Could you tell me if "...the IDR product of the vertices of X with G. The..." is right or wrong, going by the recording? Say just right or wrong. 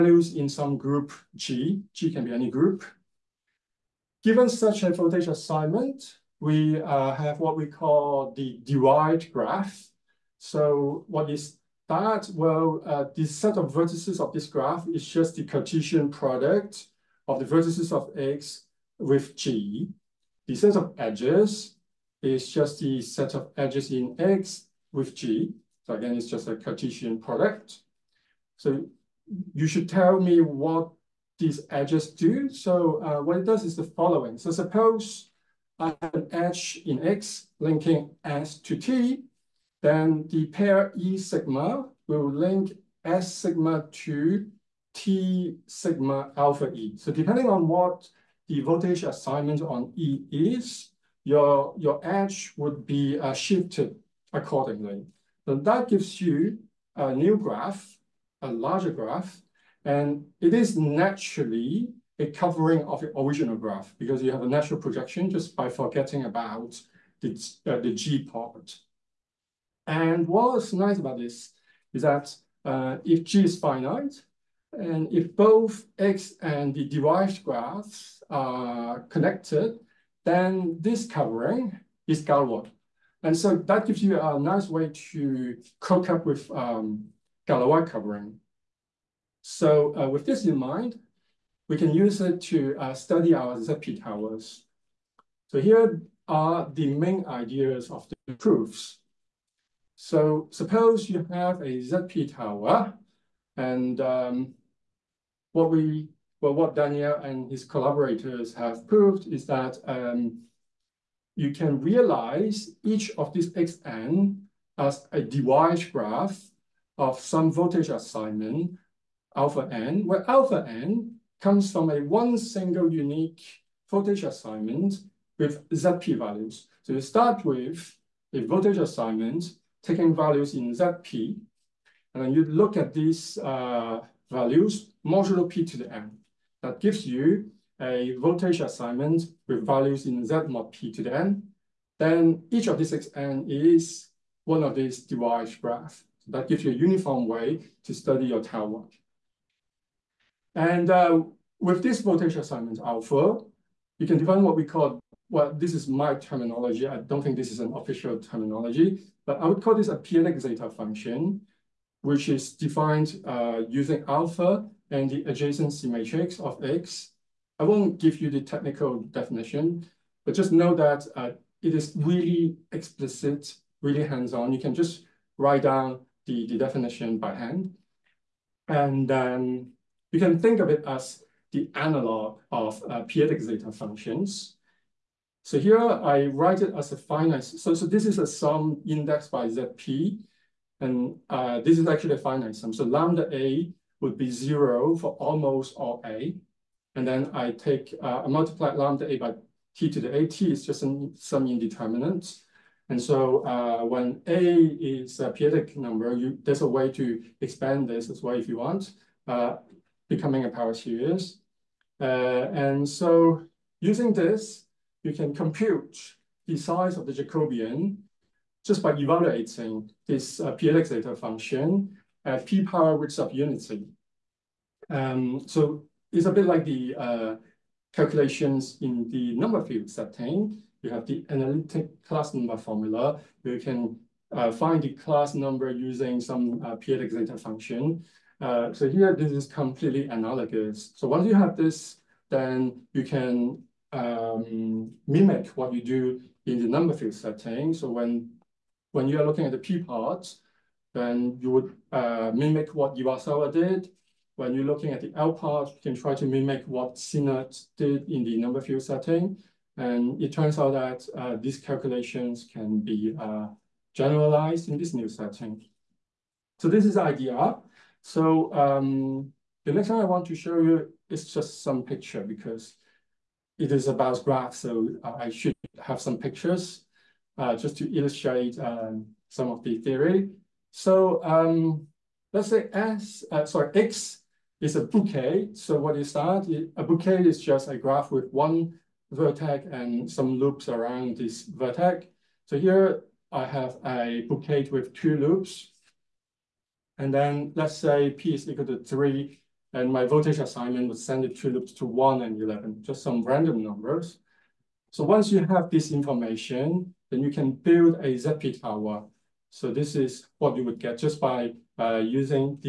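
wrong.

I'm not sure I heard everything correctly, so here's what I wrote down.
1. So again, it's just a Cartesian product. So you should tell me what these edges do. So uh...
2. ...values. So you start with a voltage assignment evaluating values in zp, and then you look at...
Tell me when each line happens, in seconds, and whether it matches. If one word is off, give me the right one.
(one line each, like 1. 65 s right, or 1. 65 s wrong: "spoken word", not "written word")
1. 25 s right
2. 126 s wrong: "taking", not "evaluating".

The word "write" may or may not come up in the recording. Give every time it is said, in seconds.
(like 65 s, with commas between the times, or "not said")
175 s, 186 s.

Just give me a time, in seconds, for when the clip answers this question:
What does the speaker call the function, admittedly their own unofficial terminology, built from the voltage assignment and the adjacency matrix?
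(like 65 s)
159 s.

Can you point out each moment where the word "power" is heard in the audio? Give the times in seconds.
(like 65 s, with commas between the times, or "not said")
210 s, 222 s.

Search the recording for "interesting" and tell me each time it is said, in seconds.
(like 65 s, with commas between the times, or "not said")
not said.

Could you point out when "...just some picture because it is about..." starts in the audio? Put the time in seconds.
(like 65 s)
271 s.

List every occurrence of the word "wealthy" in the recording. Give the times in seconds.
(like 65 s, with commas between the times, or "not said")
not said.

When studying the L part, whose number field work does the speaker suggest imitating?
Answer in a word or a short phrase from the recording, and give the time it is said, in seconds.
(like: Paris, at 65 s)
Sinnott, at 256 s.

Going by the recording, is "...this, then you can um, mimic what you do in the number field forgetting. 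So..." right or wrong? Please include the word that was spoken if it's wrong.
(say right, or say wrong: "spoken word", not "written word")
wrong: "setting", not "forgetting".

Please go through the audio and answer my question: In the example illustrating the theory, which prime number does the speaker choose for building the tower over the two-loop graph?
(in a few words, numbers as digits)
3.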